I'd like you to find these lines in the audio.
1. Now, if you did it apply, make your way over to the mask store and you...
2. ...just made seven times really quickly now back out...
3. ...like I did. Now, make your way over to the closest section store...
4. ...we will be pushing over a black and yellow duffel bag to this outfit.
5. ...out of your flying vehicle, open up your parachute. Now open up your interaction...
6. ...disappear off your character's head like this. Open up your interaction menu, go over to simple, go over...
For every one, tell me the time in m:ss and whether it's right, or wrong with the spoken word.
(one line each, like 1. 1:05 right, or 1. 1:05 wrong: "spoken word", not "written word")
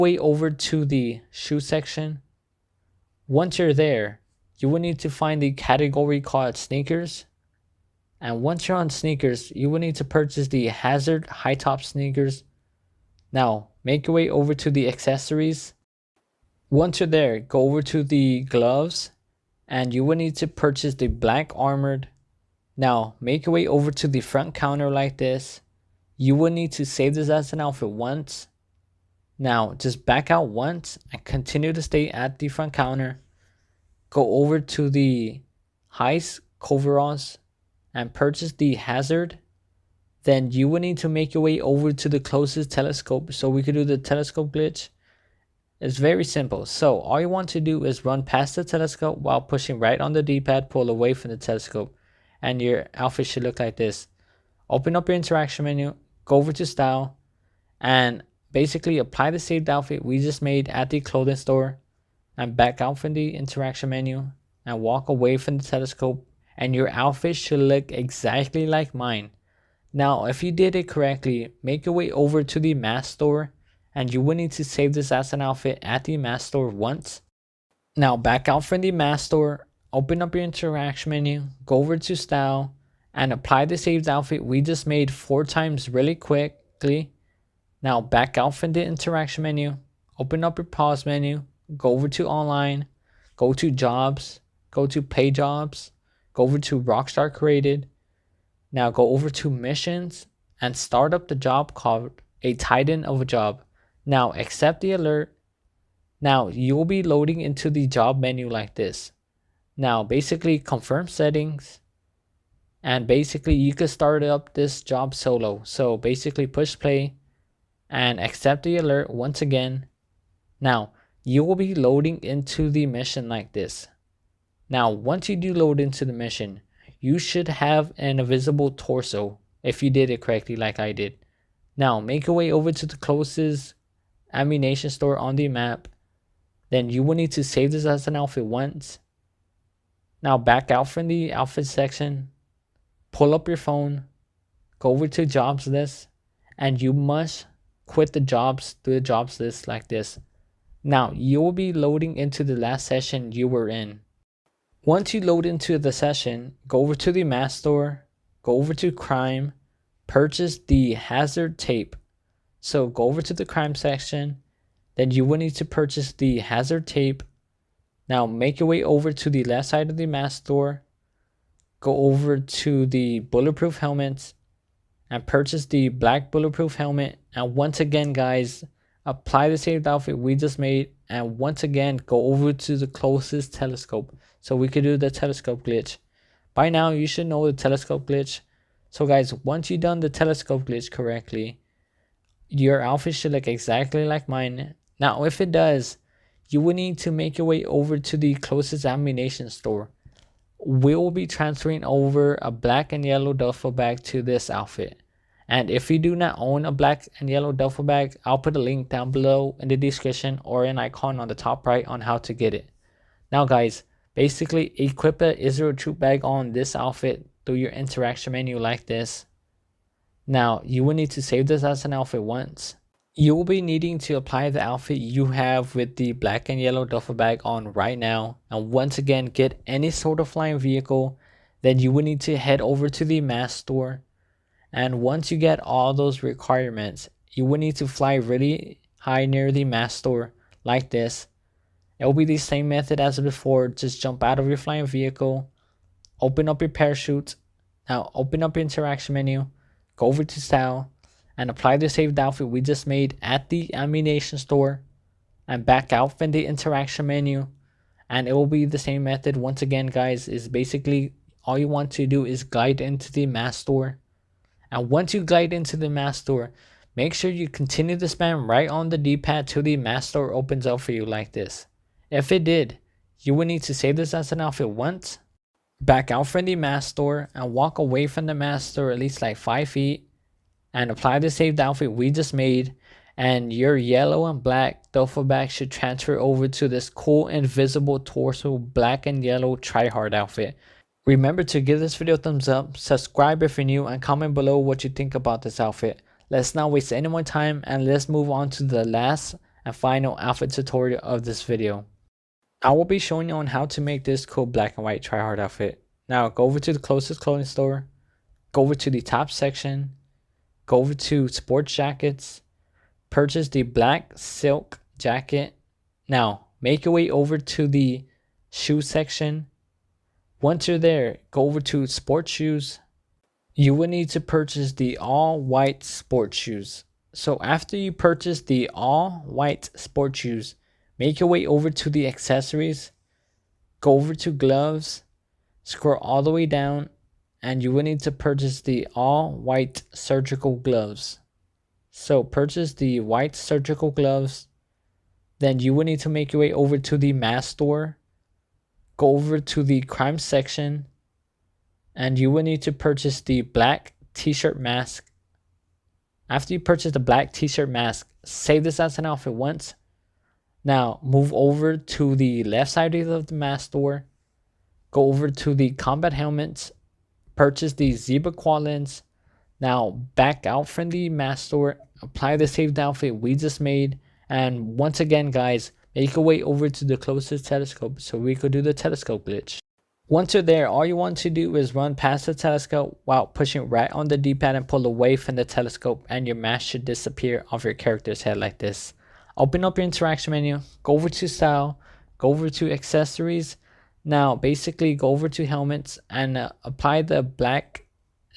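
1. 1:09 wrong: "correctly", not "apply"
2. 1:24 wrong: "four", not "seven"
3. 2:10 wrong: "ammunition", not "section"
4. 3:20 wrong: "transferring", not "pushing"
5. 4:04 right
6. 6:26 wrong: "style", not "simple".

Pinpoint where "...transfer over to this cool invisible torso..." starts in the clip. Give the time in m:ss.
4:45.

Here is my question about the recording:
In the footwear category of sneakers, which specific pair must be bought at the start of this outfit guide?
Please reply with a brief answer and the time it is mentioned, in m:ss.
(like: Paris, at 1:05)
hazard high top sneakers, at 0:10.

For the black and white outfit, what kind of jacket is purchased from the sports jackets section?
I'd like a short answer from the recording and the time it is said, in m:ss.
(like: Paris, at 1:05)
black silk jacket, at 5:13.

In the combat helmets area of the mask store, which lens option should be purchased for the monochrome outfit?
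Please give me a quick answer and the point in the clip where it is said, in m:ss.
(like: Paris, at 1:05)
Zebra lens, at 6:07.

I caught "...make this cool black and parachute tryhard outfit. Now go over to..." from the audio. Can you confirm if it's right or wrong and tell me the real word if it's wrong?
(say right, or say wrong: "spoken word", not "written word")
wrong: "white", not "parachute".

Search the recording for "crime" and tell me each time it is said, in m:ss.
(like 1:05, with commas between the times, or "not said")
2:38, 2:43, 5:49.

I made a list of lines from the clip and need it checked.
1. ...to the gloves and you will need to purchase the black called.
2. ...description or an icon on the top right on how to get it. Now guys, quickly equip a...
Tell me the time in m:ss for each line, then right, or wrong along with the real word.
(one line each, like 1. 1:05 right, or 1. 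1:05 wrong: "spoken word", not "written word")
1. 0:17 wrong: "armored", not "called"
2. 3:29 wrong: "basically", not "quickly".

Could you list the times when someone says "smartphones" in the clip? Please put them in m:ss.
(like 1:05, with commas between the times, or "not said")
not said.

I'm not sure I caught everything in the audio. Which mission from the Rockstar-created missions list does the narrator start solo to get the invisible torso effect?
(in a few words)
A Titan of a Job.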